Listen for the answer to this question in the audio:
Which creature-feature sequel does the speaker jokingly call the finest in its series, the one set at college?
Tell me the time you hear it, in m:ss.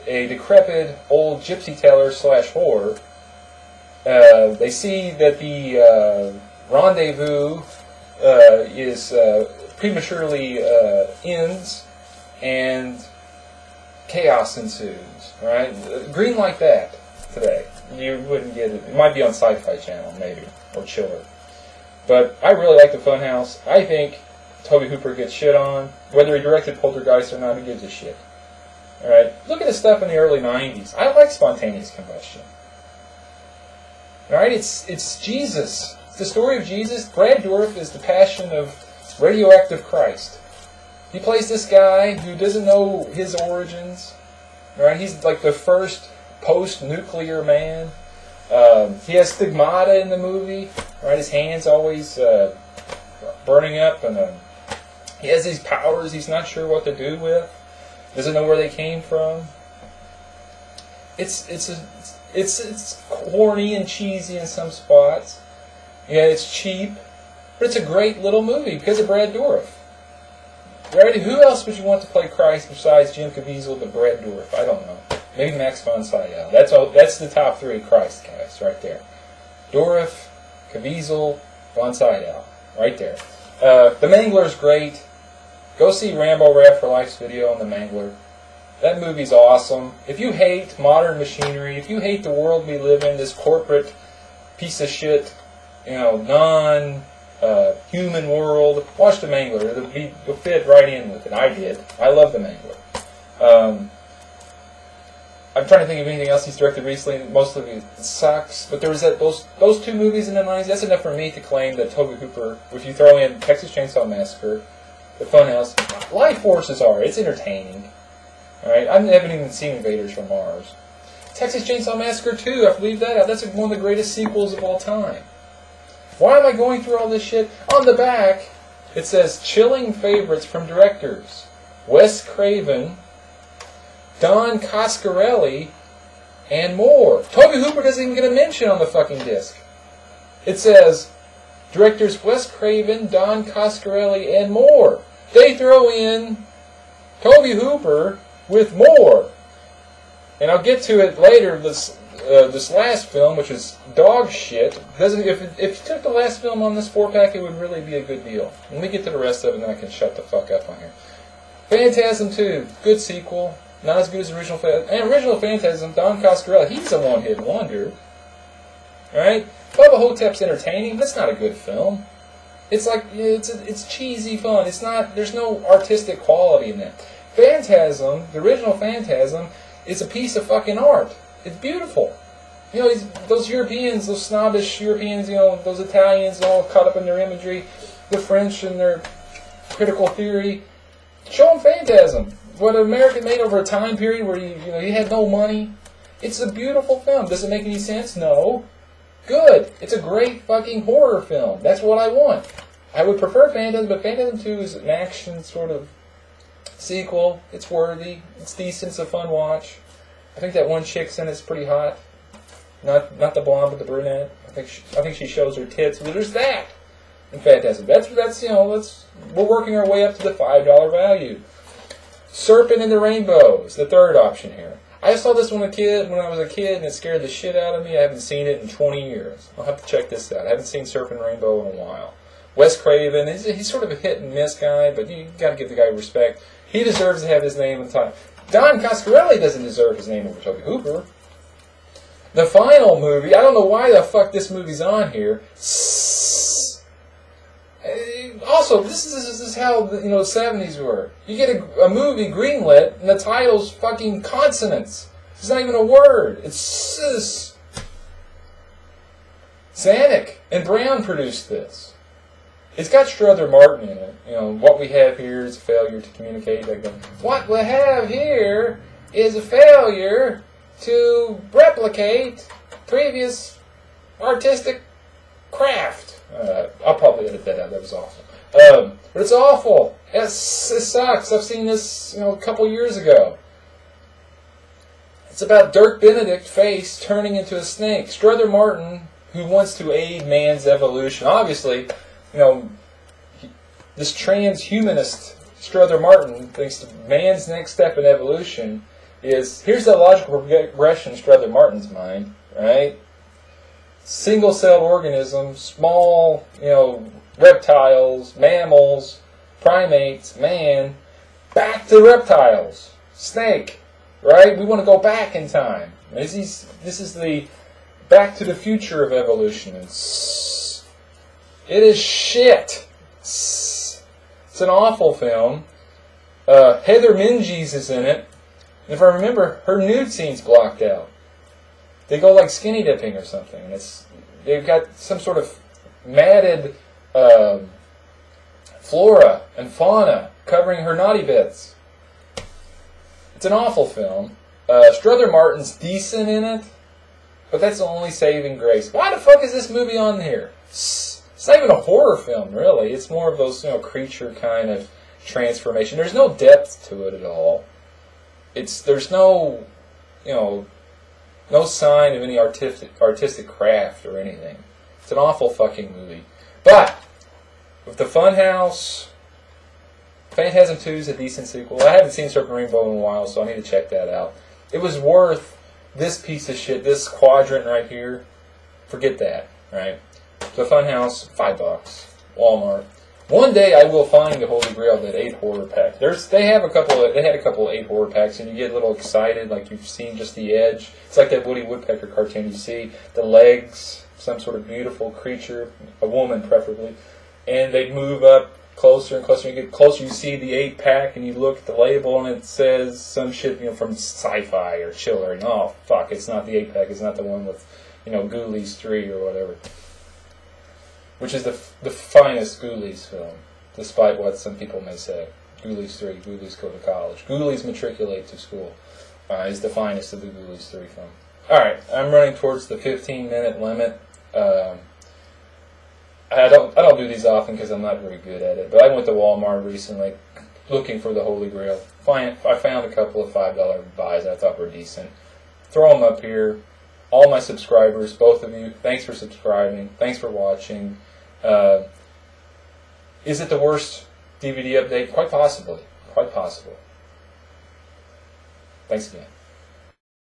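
6:48.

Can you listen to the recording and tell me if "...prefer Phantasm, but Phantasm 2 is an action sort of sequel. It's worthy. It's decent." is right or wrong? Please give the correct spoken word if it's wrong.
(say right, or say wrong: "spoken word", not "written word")
right.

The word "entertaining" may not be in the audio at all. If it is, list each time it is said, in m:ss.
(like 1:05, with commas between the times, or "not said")
1:57, 2:50.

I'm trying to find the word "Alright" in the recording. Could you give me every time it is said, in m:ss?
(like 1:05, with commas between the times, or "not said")
1:58, 7:01.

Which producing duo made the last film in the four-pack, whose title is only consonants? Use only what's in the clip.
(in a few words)
Zanuck and Brown.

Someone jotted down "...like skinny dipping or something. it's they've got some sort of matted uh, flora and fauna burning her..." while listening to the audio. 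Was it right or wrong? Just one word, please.
wrong.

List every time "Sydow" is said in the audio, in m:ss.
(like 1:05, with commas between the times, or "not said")
1:16, 1:21.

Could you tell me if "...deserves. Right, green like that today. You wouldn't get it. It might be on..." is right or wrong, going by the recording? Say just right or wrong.
wrong.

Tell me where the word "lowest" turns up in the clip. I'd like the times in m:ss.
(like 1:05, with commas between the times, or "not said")
not said.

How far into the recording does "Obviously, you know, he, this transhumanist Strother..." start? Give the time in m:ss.
4:51.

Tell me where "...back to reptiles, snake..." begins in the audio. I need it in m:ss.
5:11.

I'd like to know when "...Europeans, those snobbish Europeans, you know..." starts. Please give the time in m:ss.
3:03.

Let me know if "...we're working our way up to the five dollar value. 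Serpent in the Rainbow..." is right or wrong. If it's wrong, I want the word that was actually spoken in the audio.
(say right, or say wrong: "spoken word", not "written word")
right.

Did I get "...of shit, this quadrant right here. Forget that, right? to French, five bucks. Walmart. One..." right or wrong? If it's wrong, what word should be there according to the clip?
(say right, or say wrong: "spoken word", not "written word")
wrong: "Funhouse", not "French".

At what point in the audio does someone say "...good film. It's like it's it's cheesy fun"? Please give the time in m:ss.
2:51.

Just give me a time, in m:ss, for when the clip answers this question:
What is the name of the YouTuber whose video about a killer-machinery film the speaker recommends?
1:26.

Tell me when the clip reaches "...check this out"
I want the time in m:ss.
3:49.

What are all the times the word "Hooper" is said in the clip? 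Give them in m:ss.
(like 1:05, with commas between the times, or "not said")
0:24, 1:52, 2:17, 2:27, 4:00.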